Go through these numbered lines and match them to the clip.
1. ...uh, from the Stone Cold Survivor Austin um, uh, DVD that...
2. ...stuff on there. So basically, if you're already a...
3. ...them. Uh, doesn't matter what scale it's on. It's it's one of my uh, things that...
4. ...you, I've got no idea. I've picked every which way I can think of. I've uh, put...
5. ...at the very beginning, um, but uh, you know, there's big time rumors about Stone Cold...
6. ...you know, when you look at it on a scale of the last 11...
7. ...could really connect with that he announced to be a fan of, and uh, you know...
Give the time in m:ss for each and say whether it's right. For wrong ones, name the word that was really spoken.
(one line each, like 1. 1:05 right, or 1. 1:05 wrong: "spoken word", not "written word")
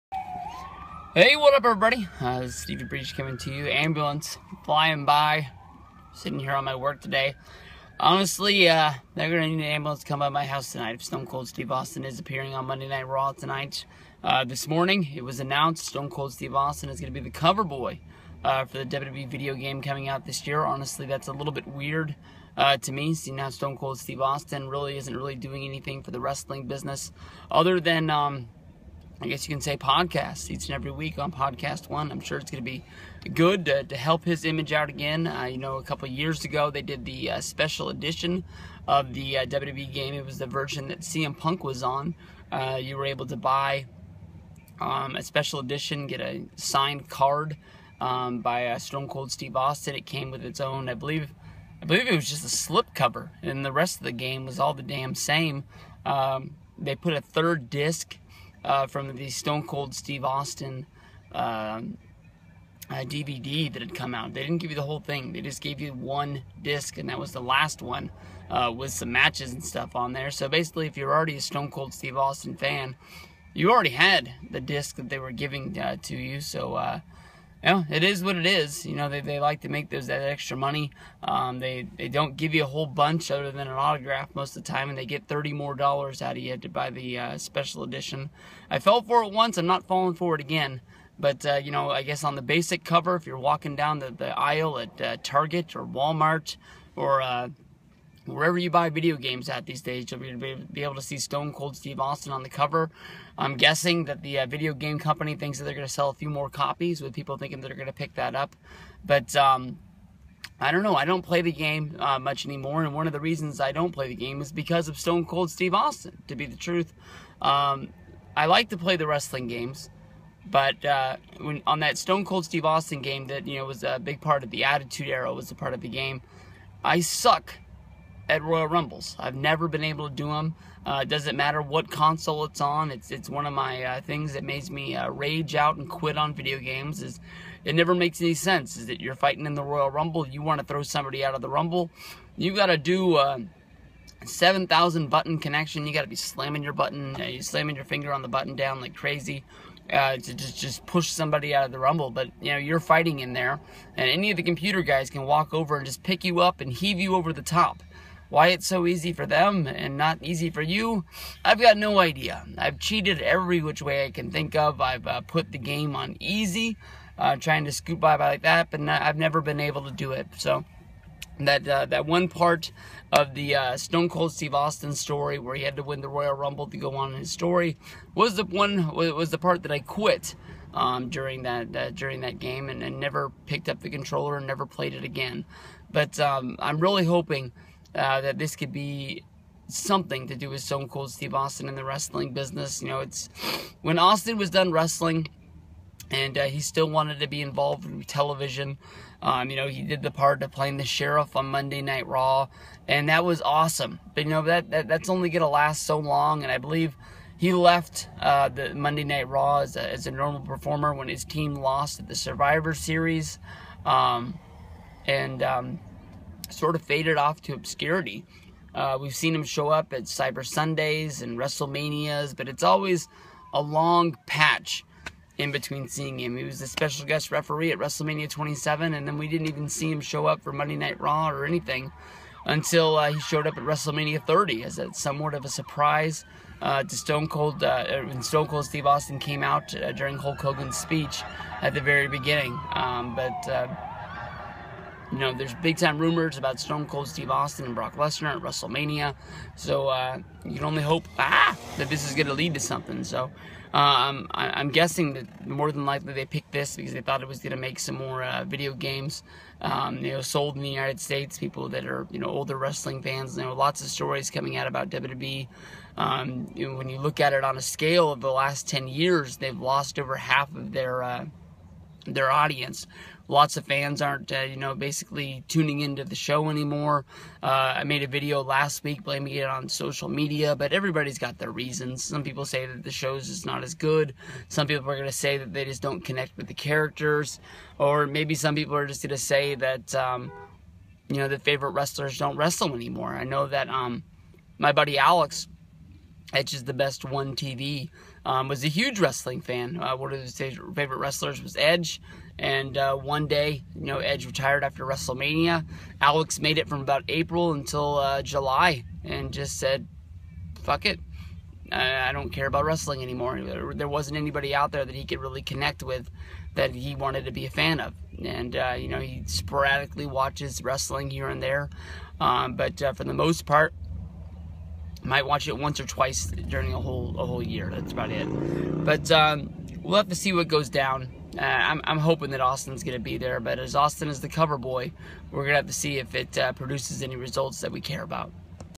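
1. 0:58 wrong: "Steve", not "Survivor"
2. 1:09 right
3. 2:10 wrong: "console", not "scale"
4. 2:40 wrong: "cheated", not "picked"
5. 4:01 right
6. 4:26 wrong: "10", not "11"
7. 5:15 wrong: "wanted", not "announced".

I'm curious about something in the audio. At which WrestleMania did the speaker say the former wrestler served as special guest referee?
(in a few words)
WrestleMania 27.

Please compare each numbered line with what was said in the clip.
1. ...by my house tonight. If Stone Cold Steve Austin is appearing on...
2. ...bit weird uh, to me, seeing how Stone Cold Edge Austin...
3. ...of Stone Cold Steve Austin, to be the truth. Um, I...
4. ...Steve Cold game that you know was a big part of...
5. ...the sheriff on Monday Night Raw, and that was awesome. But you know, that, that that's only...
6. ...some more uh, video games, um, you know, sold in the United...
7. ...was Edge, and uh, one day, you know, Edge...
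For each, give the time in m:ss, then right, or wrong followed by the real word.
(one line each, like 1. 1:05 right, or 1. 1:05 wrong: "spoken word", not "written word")
1. 0:10 right
2. 0:21 wrong: "Steve", not "Edge"
3. 1:54 right
4. 2:02 wrong: "Austin", not "Cold"
5. 3:20 right
6. 4:17 right
7. 5:01 right.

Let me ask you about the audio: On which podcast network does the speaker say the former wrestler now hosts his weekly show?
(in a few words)
Podcast One.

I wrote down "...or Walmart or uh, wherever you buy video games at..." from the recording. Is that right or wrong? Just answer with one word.
right.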